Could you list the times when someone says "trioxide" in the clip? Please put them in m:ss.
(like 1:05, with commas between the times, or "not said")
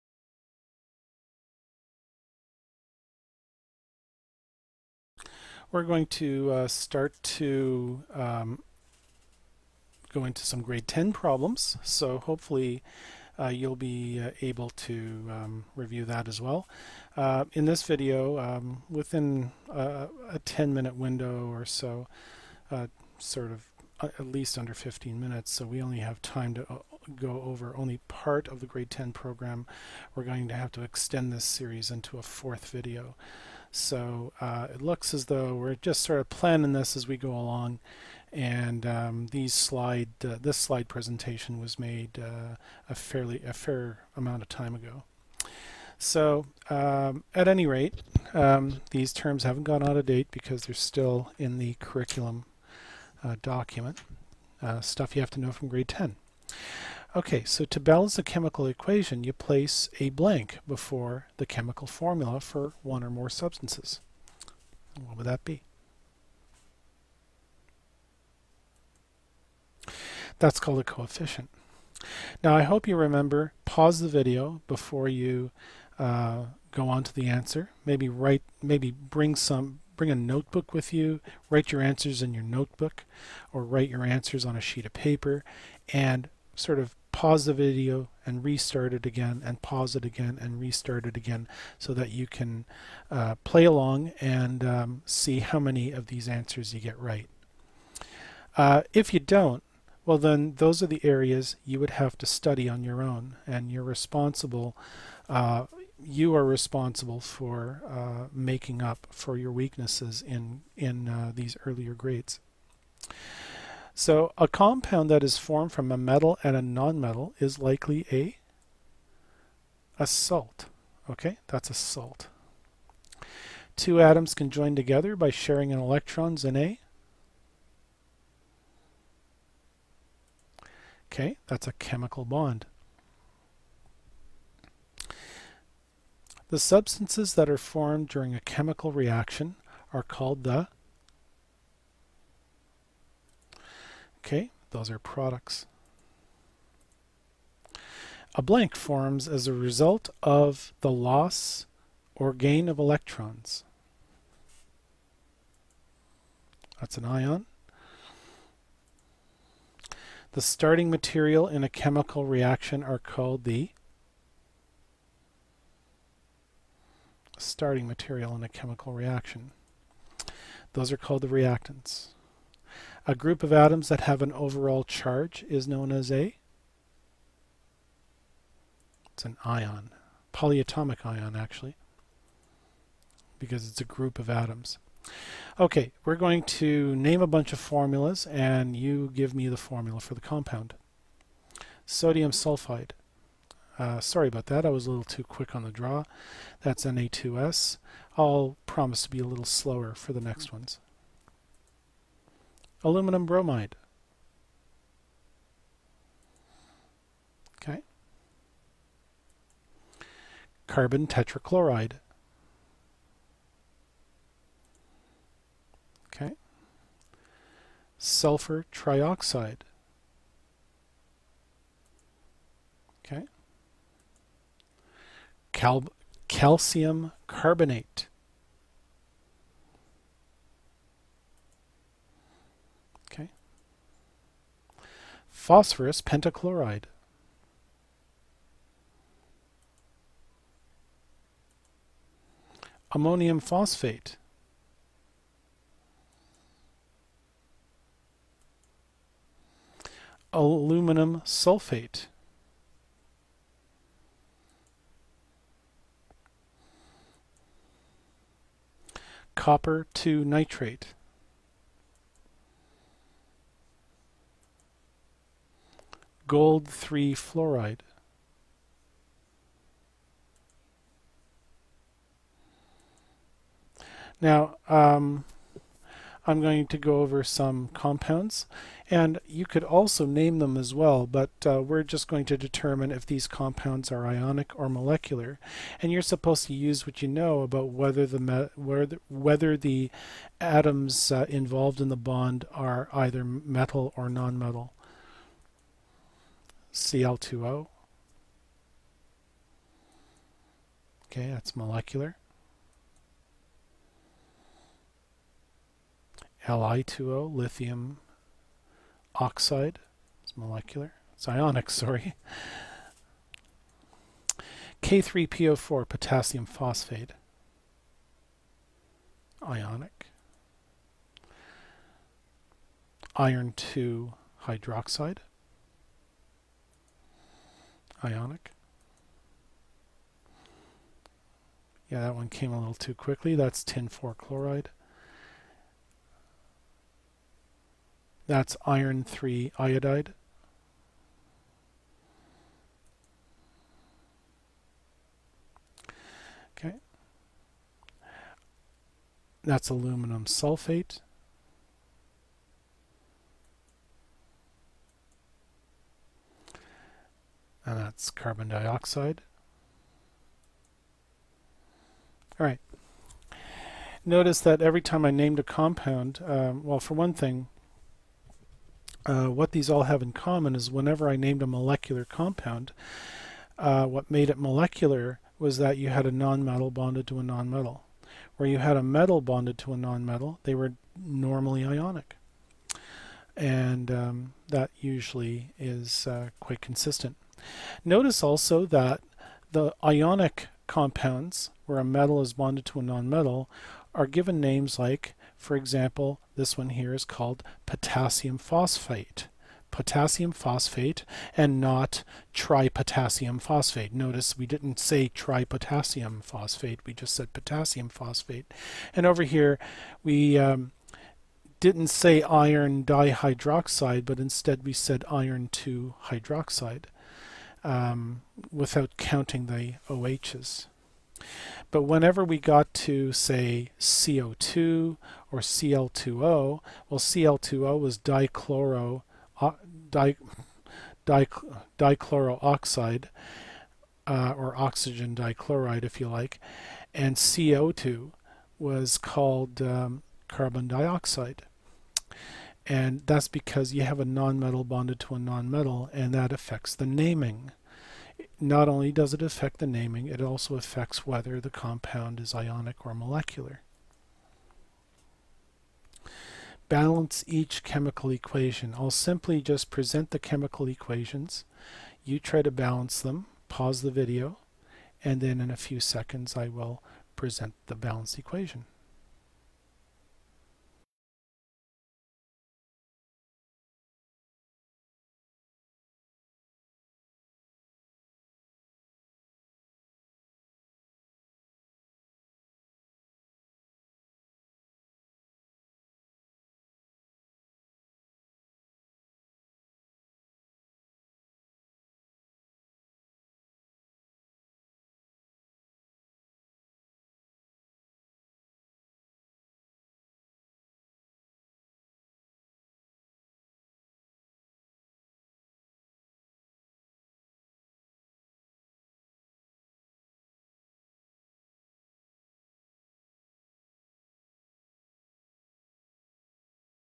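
3:38.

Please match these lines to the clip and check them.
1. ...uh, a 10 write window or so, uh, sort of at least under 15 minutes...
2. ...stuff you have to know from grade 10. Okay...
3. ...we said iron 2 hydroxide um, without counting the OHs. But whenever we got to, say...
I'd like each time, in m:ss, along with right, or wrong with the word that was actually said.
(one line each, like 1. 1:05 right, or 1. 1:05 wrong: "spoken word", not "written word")
1. 0:19 wrong: "minute", not "write"
2. 0:54 right
3. 6:54 right.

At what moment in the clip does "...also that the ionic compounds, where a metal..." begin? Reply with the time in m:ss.
6:28.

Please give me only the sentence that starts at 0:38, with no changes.
And um, these slide, uh, this slide presentation was made uh, a fairly a fair amount of time ago.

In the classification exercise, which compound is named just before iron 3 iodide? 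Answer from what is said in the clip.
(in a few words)
tin 4 chloride.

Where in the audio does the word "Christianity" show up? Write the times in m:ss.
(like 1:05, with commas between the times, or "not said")
not said.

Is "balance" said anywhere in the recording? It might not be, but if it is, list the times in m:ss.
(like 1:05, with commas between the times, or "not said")
0:57, 7:36, 7:42, 7:47.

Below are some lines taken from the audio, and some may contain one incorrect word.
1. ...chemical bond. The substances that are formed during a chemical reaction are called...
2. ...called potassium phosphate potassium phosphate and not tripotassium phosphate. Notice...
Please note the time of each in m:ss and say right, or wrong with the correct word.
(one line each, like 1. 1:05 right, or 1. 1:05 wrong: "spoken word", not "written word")
1. 2:11 right
2. 6:37 right.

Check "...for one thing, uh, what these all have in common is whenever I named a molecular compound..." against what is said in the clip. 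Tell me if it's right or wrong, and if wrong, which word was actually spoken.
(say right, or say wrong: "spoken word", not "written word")
right.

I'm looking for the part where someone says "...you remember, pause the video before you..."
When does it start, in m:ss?
1:12.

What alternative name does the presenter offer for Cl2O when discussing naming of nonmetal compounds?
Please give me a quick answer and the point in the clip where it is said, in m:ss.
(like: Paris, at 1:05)
oxygen dichloride, at 7:14.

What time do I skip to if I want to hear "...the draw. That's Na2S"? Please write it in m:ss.
3:15.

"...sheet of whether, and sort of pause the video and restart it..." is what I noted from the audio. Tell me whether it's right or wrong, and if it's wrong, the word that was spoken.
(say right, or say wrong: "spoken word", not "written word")
wrong: "paper", not "whether".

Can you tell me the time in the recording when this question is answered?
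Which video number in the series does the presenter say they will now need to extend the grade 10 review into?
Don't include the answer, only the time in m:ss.
0:32.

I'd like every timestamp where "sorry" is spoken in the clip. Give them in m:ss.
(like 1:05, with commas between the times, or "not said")
3:13, 5:11.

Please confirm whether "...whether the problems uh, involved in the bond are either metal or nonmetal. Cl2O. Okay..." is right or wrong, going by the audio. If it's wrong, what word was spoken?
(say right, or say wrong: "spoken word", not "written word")
wrong: "atoms", not "problems".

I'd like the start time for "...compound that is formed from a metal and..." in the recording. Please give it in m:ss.
1:54.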